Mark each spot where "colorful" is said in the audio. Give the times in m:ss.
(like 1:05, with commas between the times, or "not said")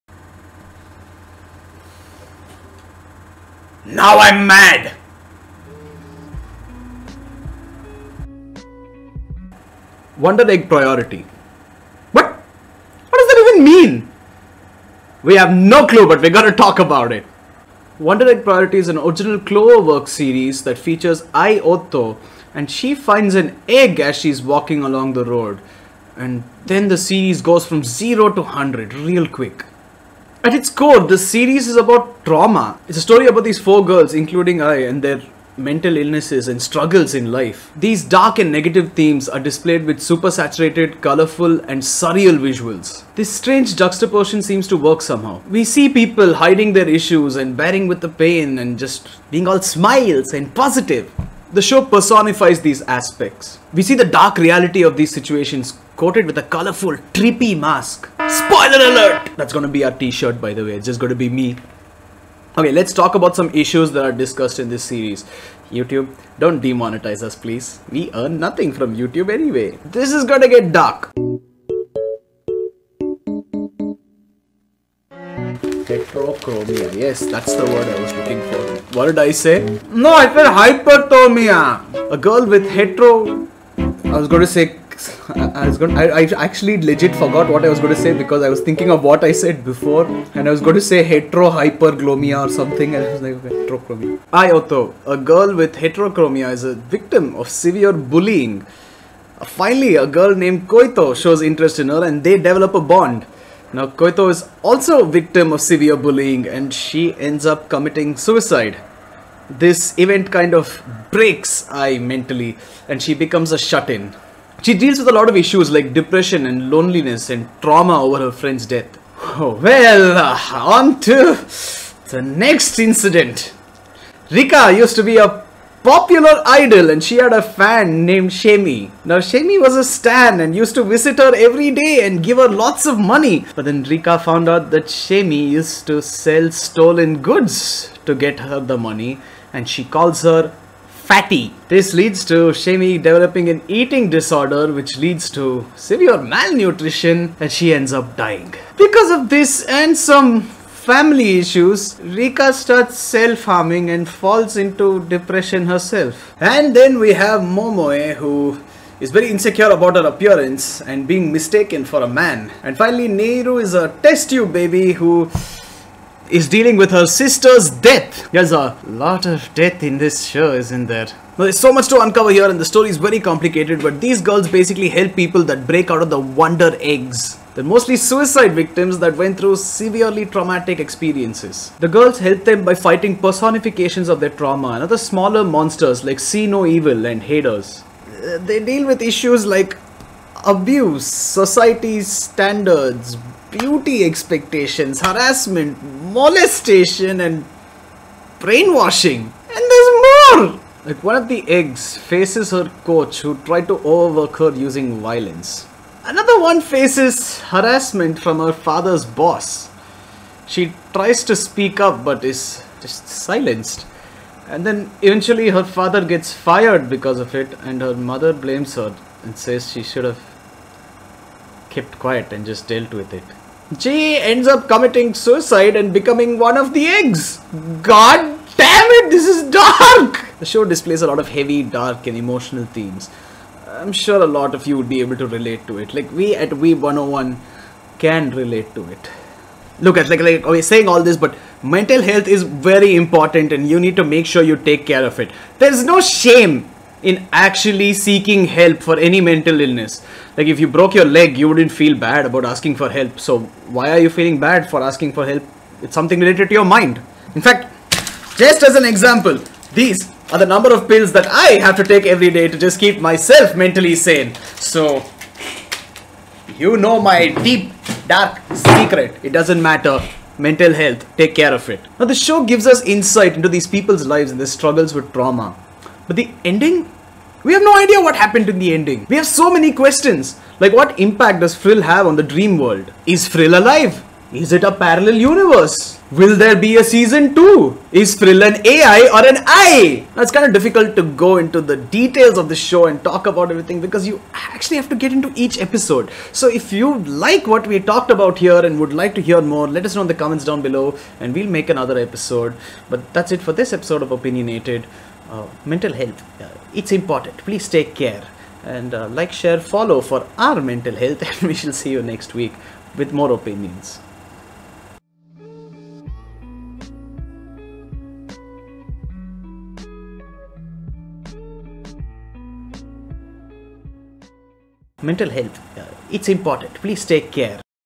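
0:40, 0:56.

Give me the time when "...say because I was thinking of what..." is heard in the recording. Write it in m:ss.
1:28.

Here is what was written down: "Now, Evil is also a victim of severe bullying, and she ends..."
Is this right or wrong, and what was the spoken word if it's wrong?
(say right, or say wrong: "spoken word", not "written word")
wrong: "Koito", not "Evil".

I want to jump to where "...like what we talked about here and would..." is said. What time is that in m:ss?
4:57.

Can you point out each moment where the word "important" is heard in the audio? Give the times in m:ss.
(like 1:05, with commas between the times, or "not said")
4:02, 5:06, 5:26.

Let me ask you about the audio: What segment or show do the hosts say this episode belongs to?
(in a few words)
Opinionated.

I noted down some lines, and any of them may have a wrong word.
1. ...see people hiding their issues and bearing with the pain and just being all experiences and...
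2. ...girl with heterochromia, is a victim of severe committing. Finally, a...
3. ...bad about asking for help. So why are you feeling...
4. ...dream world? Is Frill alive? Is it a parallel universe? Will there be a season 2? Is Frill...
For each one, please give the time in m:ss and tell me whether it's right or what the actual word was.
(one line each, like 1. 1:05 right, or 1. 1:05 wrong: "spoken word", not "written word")
1. 0:45 wrong: "smiles", not "experiences"
2. 1:35 wrong: "bullying", not "committing"
3. 4:11 right
4. 4:42 right.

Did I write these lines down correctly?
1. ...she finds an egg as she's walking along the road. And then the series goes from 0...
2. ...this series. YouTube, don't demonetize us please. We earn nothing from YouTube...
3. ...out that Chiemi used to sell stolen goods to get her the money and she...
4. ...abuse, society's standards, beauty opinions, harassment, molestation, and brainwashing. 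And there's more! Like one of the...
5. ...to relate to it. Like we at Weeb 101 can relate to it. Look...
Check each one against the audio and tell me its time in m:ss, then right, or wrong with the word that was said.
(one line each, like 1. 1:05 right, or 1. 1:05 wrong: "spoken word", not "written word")
1. 0:22 right
2. 1:04 right
3. 2:14 right
4. 3:10 wrong: "expectations", not "opinions"
5. 3:55 right.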